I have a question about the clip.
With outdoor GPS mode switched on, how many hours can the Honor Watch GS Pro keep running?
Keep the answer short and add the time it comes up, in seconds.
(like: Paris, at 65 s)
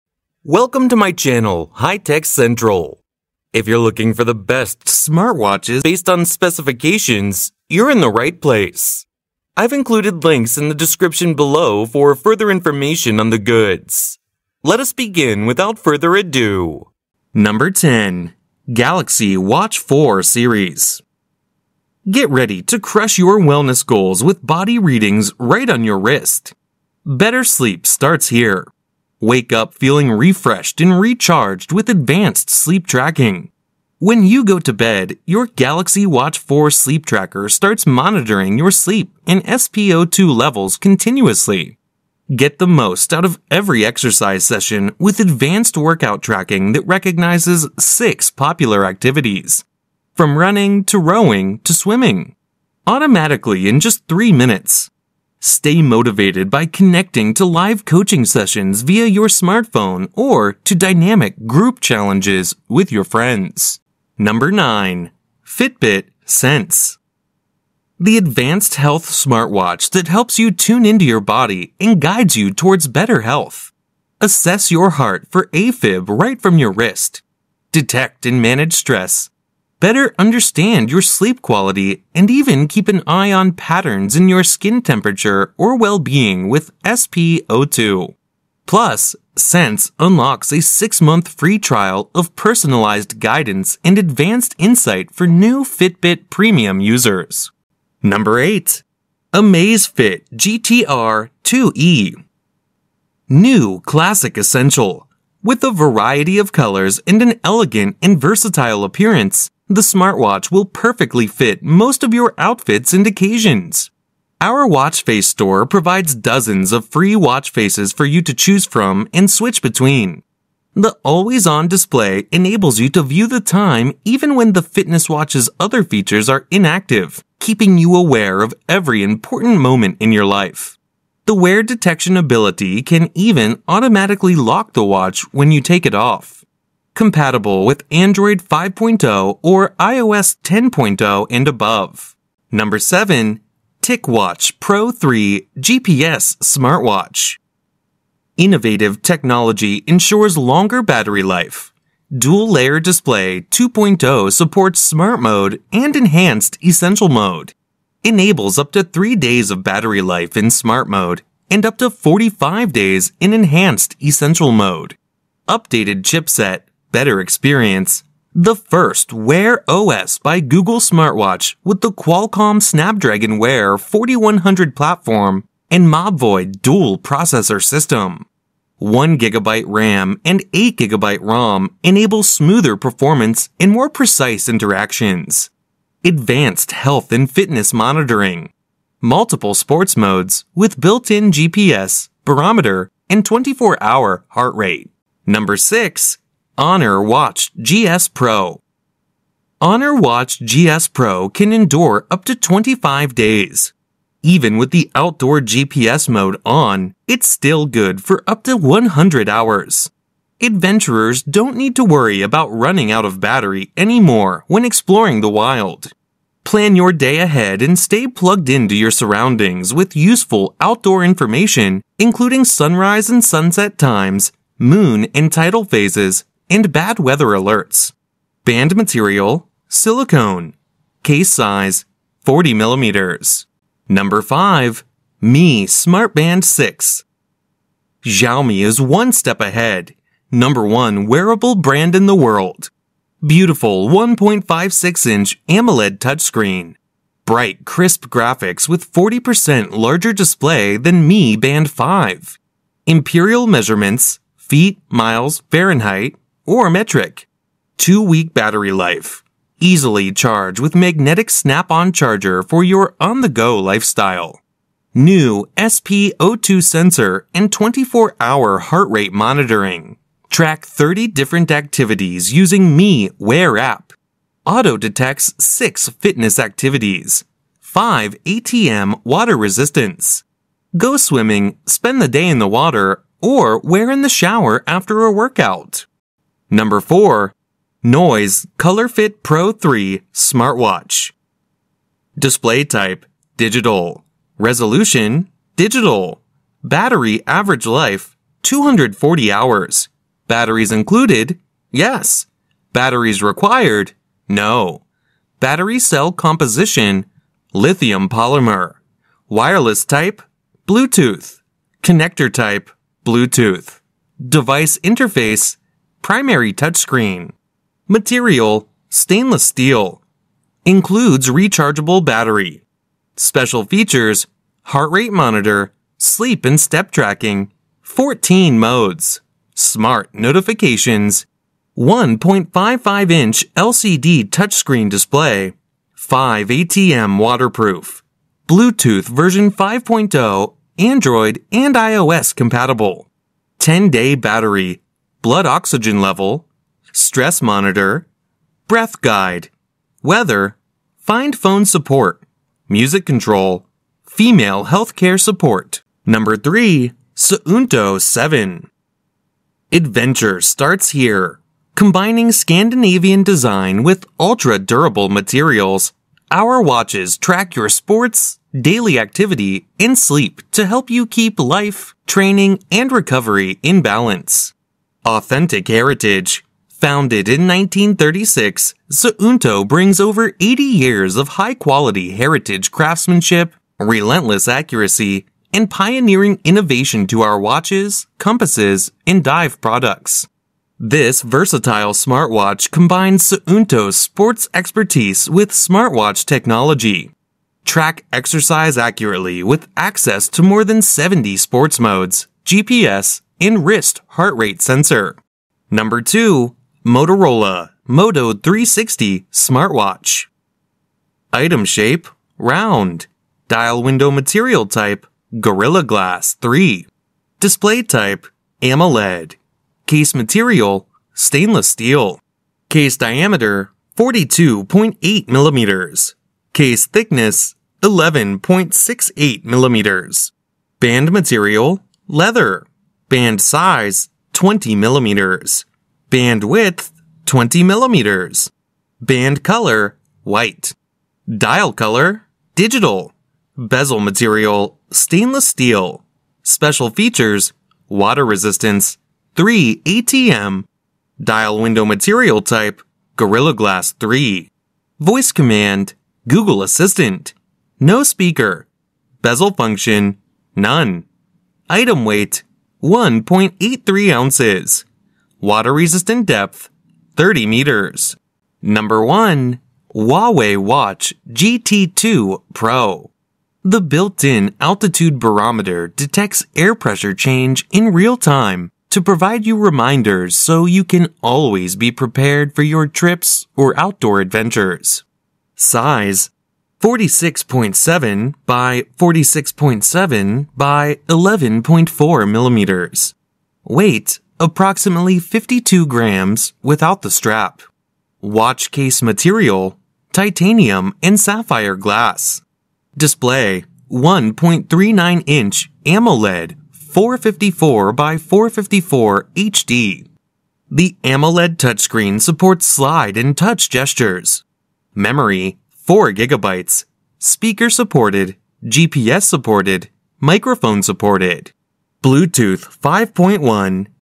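100 hours, at 208 s.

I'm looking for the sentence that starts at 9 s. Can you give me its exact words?
I've included links in the description below for further information on the goods.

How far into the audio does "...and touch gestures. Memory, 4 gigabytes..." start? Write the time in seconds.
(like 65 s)
513 s.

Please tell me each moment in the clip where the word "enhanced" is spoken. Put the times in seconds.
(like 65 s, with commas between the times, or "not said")
155 s, 163 s.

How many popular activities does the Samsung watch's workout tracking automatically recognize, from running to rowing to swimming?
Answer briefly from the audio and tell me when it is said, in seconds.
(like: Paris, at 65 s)
6, at 47 s.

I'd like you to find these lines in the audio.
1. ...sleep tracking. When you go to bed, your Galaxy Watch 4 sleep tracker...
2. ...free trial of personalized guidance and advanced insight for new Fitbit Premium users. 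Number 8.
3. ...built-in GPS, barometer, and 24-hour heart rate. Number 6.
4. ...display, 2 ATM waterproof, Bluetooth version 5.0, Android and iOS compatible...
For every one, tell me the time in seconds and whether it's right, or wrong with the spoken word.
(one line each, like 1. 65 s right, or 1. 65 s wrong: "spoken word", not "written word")
1. 32 s right
2. 91 s right
3. 190 s right
4. 334 s wrong: "5", not "2".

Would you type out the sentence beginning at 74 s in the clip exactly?
Assess your heart for AFib right from your wrist.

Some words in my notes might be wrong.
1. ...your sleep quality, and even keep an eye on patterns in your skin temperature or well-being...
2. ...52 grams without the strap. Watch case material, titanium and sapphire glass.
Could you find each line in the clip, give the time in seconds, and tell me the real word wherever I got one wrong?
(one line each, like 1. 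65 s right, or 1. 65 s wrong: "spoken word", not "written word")
1. 80 s right
2. 495 s right.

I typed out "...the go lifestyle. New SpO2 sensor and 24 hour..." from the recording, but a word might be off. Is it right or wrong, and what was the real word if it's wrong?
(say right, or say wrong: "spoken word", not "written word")
right.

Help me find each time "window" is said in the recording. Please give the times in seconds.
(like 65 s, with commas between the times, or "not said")
413 s, 451 s.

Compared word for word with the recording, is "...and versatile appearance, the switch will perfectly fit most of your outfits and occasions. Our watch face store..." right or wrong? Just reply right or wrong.
wrong.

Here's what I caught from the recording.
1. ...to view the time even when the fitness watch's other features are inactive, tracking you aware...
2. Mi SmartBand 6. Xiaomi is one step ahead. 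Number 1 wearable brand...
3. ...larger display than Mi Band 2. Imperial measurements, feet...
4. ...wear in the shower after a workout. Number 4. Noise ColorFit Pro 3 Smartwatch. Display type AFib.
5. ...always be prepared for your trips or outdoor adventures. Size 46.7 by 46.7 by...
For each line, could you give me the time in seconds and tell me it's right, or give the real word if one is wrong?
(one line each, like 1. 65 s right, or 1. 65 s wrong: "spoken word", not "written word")
1. 122 s wrong: "keeping", not "tracking"
2. 235 s right
3. 249 s wrong: "5", not "2"
4. 283 s wrong: "Digital", not "AFib"
5. 481 s right.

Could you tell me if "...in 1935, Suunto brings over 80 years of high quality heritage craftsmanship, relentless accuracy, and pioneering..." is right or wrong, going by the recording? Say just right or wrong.
wrong.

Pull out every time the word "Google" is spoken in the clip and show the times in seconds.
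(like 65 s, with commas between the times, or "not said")
170 s, 456 s.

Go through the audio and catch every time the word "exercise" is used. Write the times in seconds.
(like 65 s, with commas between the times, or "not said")
43 s, 398 s.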